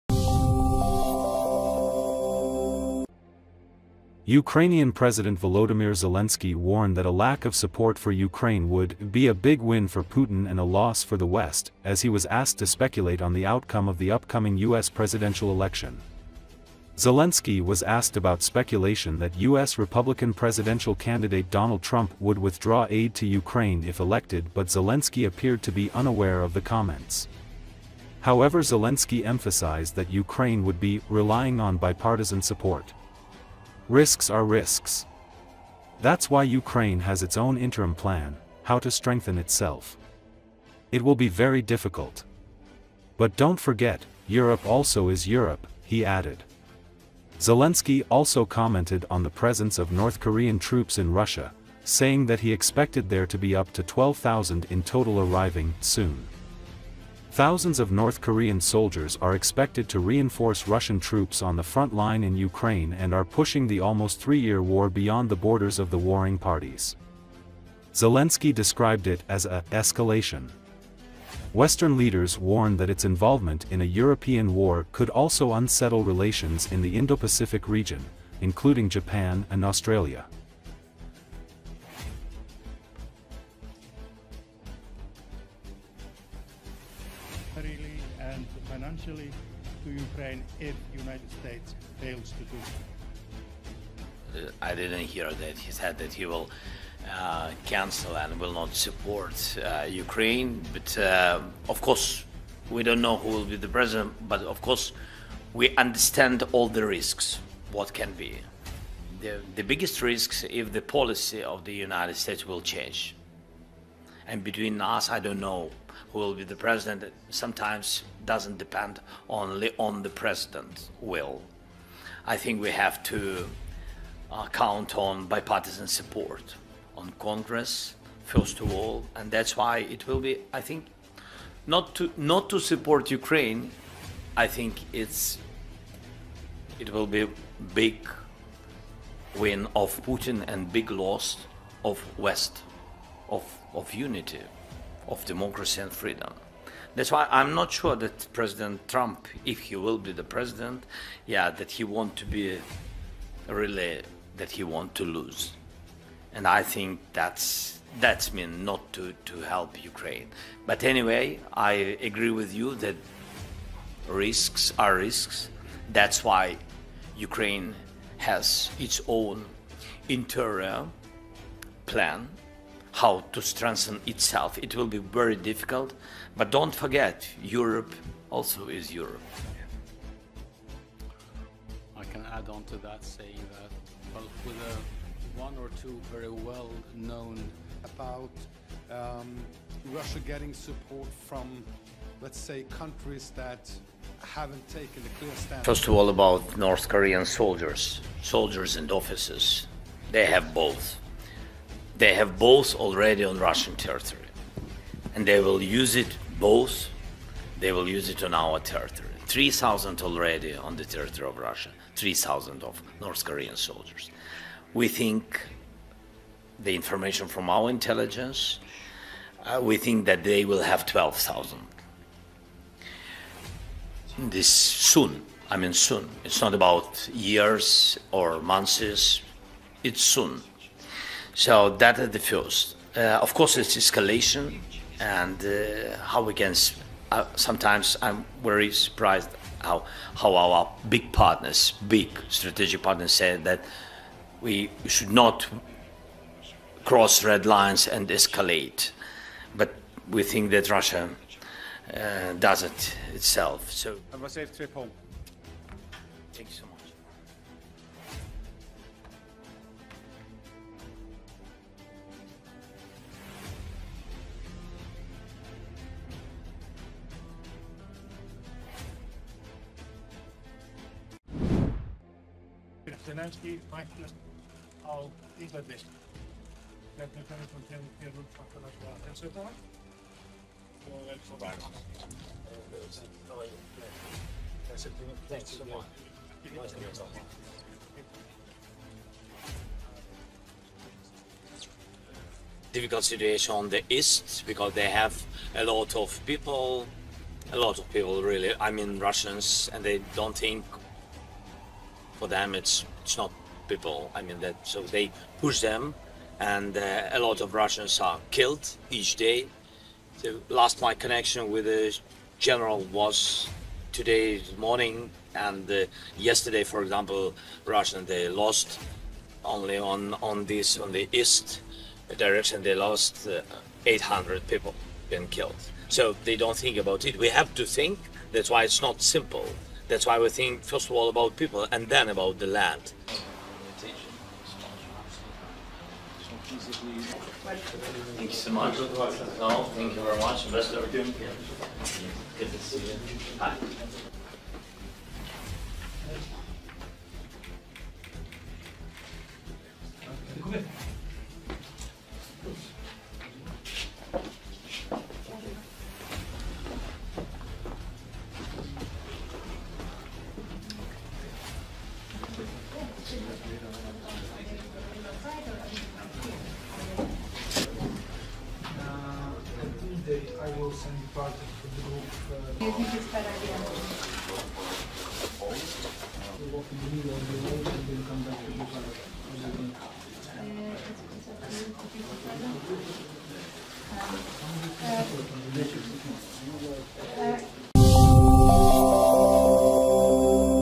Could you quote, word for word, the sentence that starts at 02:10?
I think not to not to support Ukraine.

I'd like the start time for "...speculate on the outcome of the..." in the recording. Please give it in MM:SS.
00:12.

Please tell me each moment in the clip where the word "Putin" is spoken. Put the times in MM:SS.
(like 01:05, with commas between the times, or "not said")
00:10, 02:20.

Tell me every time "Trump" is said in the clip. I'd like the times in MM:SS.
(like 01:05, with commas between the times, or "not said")
00:21, 02:28.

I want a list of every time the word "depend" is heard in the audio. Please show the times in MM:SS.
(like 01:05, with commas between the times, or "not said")
01:58.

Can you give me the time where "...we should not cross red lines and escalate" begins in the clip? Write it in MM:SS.
04:04.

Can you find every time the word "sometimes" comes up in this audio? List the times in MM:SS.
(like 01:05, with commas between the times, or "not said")
01:57, 03:57.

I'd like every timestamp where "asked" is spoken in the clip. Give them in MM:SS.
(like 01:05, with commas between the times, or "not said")
00:12, 00:17.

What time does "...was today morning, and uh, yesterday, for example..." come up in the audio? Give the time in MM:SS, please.
05:12.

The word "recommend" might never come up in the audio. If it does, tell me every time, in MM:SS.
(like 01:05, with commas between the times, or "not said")
not said.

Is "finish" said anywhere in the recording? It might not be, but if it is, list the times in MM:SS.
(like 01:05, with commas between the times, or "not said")
04:37.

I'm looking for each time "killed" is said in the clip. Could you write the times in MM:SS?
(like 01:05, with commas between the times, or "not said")
05:08, 05:25.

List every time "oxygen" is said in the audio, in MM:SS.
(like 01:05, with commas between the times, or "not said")
not said.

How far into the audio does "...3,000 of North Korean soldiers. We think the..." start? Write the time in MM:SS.
03:31.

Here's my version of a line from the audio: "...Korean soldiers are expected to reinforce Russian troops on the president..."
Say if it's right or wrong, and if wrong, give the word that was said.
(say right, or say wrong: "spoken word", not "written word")
wrong: "front", not "president".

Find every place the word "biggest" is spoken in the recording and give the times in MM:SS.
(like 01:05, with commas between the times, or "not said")
01:49.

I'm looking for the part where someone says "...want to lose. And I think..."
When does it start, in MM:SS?
02:34.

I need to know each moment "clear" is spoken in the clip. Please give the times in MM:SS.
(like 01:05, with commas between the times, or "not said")
03:15.